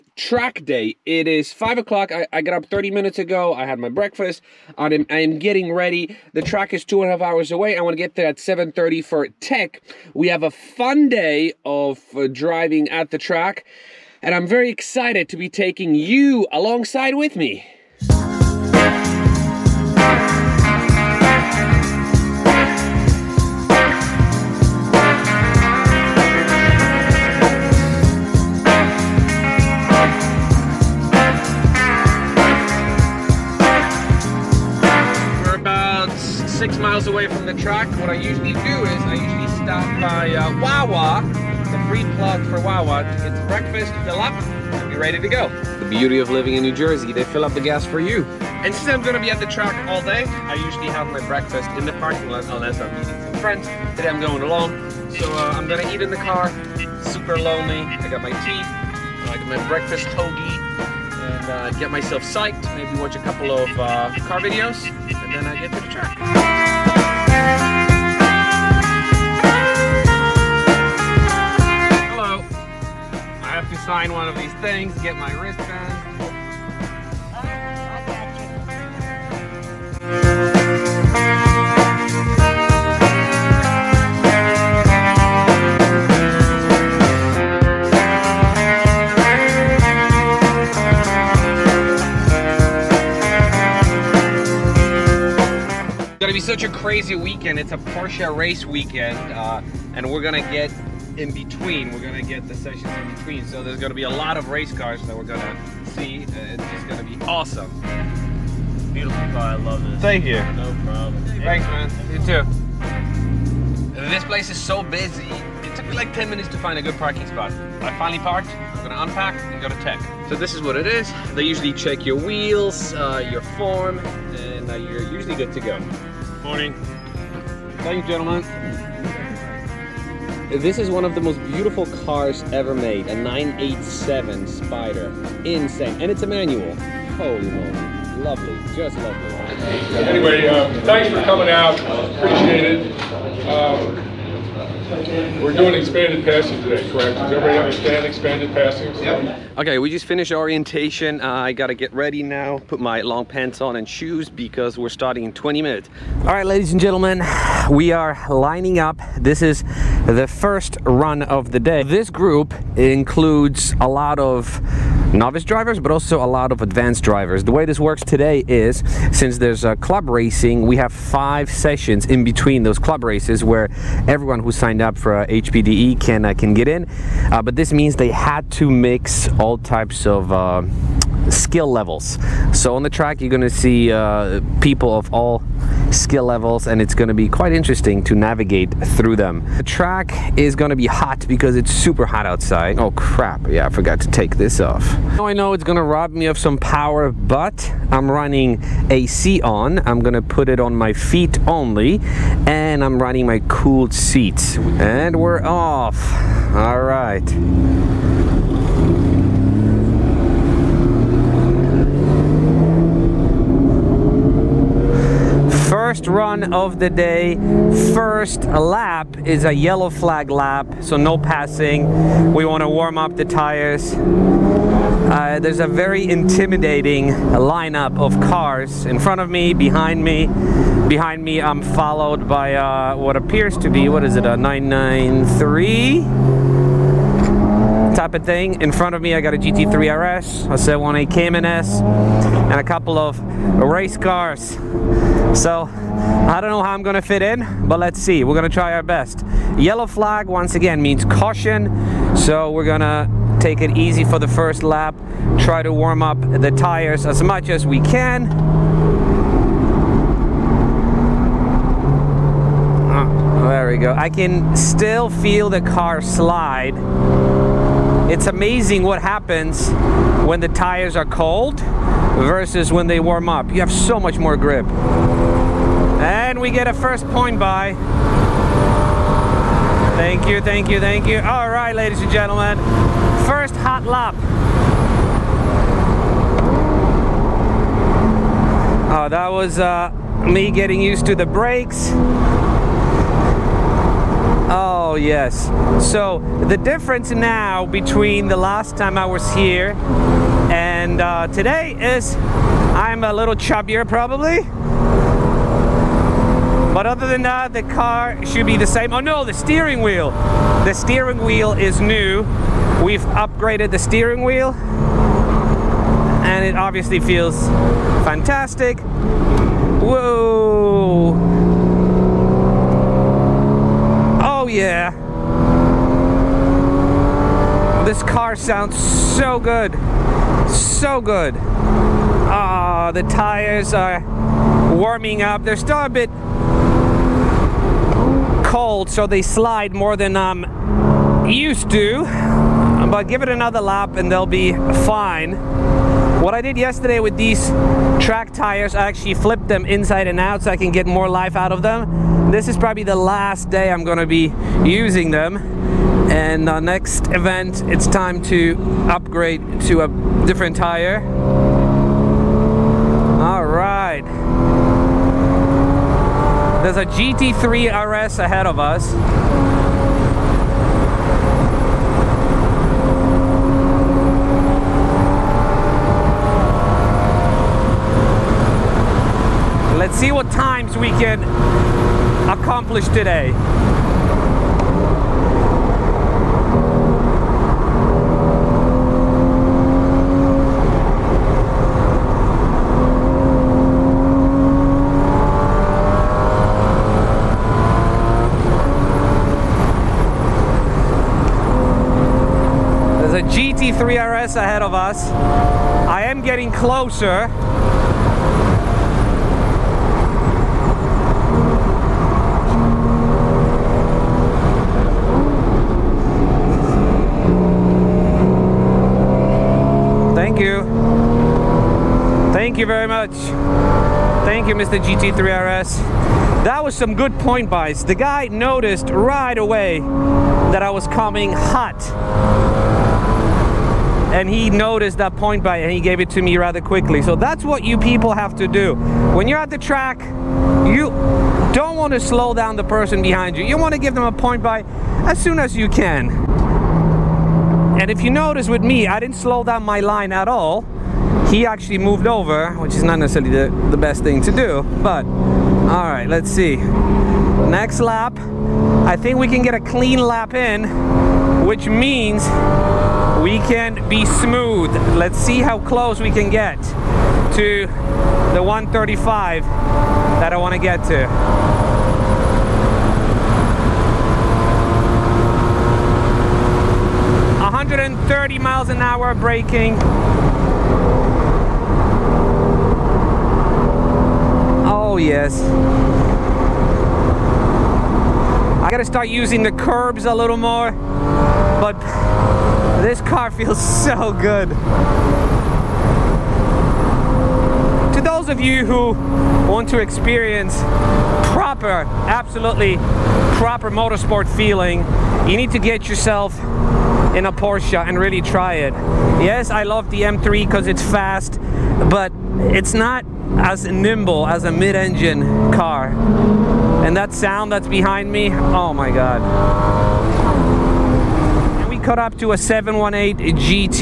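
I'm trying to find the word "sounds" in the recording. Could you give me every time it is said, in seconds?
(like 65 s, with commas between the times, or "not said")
328 s, 517 s.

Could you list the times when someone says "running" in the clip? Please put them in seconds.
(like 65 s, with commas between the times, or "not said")
198 s, 203 s.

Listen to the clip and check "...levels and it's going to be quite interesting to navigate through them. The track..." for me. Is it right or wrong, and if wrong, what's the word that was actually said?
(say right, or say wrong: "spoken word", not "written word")
right.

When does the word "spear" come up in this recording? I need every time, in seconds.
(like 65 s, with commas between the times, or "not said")
not said.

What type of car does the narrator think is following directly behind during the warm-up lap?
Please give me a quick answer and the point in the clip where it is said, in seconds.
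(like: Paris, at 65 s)
993, at 234 s.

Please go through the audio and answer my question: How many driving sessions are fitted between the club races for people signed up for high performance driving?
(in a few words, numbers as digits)
5.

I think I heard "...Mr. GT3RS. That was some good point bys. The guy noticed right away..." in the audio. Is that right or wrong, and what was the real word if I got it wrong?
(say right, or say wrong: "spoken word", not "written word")
right.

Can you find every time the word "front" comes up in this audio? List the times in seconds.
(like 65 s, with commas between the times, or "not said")
228 s, 238 s.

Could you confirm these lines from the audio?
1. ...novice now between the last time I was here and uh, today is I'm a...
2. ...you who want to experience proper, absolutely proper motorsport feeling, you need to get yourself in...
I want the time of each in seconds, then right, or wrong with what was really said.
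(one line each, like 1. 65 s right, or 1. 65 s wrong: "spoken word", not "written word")
1. 296 s wrong: "difference", not "novice"
2. 498 s right.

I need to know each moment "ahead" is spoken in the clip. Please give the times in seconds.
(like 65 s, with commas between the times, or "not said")
368 s, 404 s.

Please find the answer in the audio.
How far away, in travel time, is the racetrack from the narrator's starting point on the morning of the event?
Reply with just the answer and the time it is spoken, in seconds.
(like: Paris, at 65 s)
2.5 hours, at 6 s.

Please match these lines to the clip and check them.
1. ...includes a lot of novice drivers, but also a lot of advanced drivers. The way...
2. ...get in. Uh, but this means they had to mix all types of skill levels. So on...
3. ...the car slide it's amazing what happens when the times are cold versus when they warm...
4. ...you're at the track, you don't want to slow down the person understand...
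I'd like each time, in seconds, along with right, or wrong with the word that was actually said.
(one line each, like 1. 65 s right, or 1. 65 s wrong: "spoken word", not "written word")
1. 162 s right
2. 176 s right
3. 265 s wrong: "tires", not "times"
4. 439 s wrong: "behind", not "understand".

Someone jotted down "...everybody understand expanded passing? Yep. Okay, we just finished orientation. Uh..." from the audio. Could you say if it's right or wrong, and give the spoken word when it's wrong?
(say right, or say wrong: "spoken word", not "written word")
right.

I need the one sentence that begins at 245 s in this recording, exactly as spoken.
So I don't know how I'm gonna fit in, but let's see.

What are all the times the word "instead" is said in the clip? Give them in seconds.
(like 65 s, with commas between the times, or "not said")
not said.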